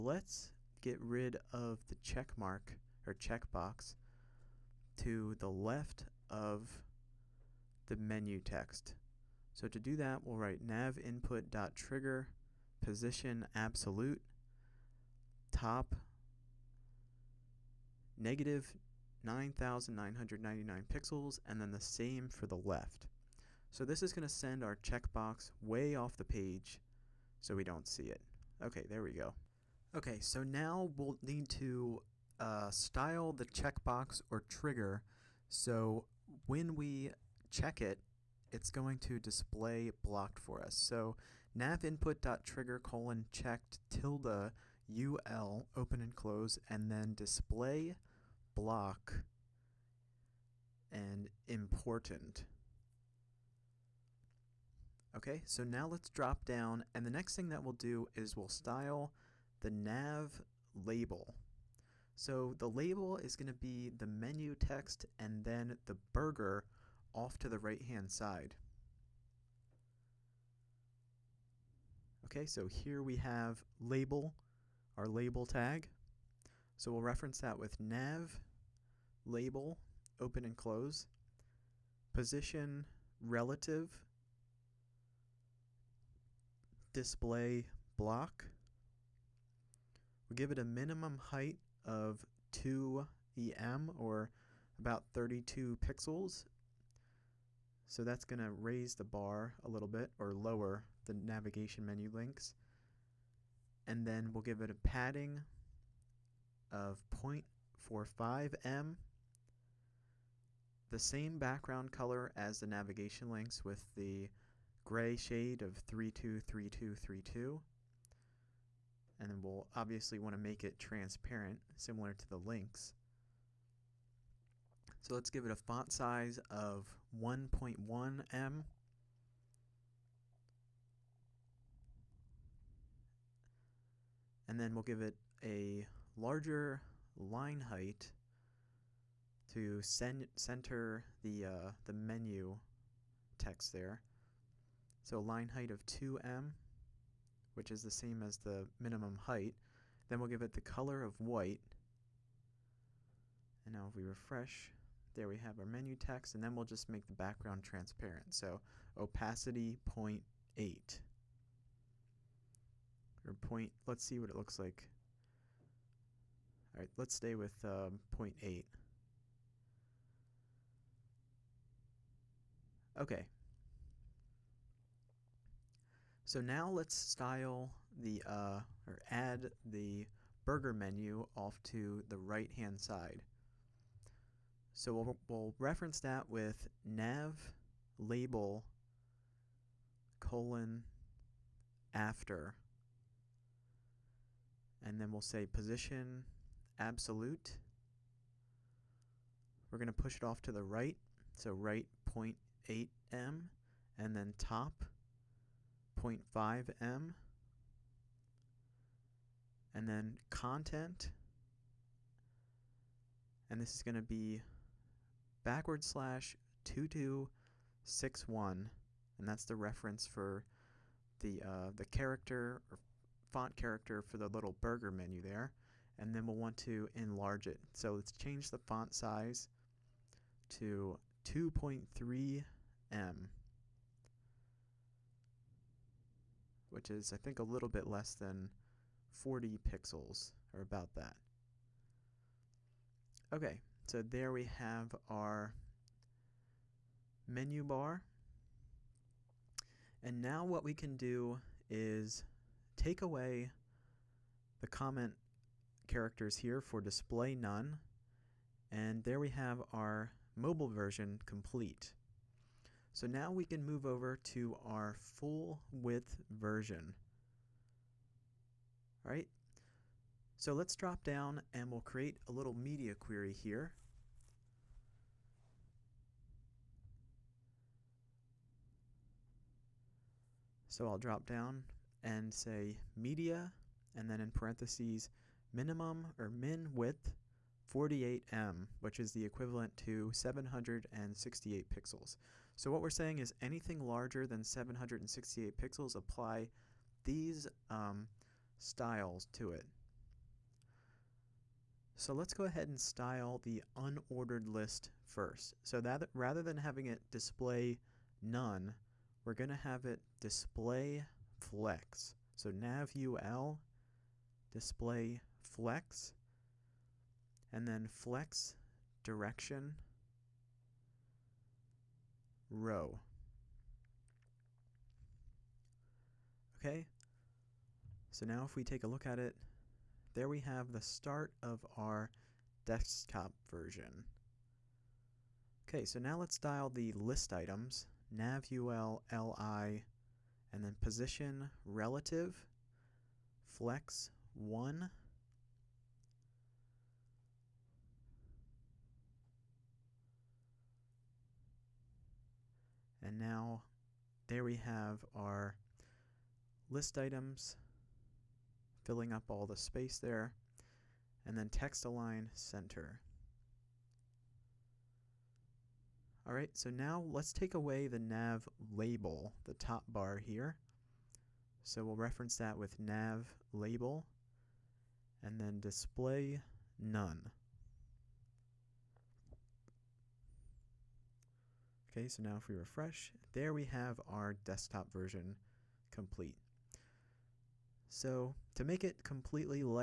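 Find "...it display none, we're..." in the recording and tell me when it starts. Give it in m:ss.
5:06.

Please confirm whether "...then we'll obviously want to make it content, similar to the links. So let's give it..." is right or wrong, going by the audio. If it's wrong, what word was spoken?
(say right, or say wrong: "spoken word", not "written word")
wrong: "transparent", not "content".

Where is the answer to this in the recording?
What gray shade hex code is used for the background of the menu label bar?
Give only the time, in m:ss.
1:55.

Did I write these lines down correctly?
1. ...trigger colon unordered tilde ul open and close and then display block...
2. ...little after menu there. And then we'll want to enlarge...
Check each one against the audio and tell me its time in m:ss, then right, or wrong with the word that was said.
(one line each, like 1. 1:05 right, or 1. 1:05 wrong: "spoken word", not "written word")
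1. 0:42 wrong: "checked", not "unordered"
2. 3:44 wrong: "burger", not "after".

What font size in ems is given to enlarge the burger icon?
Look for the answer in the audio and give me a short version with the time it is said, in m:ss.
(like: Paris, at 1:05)
2.3 em, at 3:51.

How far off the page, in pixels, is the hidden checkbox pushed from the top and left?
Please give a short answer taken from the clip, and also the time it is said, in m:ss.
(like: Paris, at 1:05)
-9999 pixels, at 0:18.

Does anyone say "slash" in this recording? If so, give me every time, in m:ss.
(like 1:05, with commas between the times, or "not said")
3:35.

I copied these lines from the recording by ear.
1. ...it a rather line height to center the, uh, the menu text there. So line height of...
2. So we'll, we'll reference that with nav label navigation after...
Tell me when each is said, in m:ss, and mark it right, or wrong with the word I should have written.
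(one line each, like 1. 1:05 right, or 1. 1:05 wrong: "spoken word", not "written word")
1. 2:15 wrong: "larger", not "rather"
2. 3:04 wrong: "colon", not "navigation".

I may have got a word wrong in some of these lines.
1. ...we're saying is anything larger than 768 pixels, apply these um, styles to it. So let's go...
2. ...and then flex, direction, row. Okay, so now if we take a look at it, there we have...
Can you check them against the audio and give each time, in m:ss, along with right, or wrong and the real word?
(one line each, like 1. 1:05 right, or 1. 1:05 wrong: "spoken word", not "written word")
1. 4:52 right
2. 5:17 right.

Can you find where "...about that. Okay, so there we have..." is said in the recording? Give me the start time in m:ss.
4:00.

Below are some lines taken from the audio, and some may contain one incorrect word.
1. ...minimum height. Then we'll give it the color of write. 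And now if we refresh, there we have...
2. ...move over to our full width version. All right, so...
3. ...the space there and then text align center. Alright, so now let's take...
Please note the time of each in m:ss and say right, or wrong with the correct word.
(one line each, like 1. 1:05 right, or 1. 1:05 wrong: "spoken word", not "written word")
1. 2:28 wrong: "white", not "write"
2. 4:23 right
3. 5:59 right.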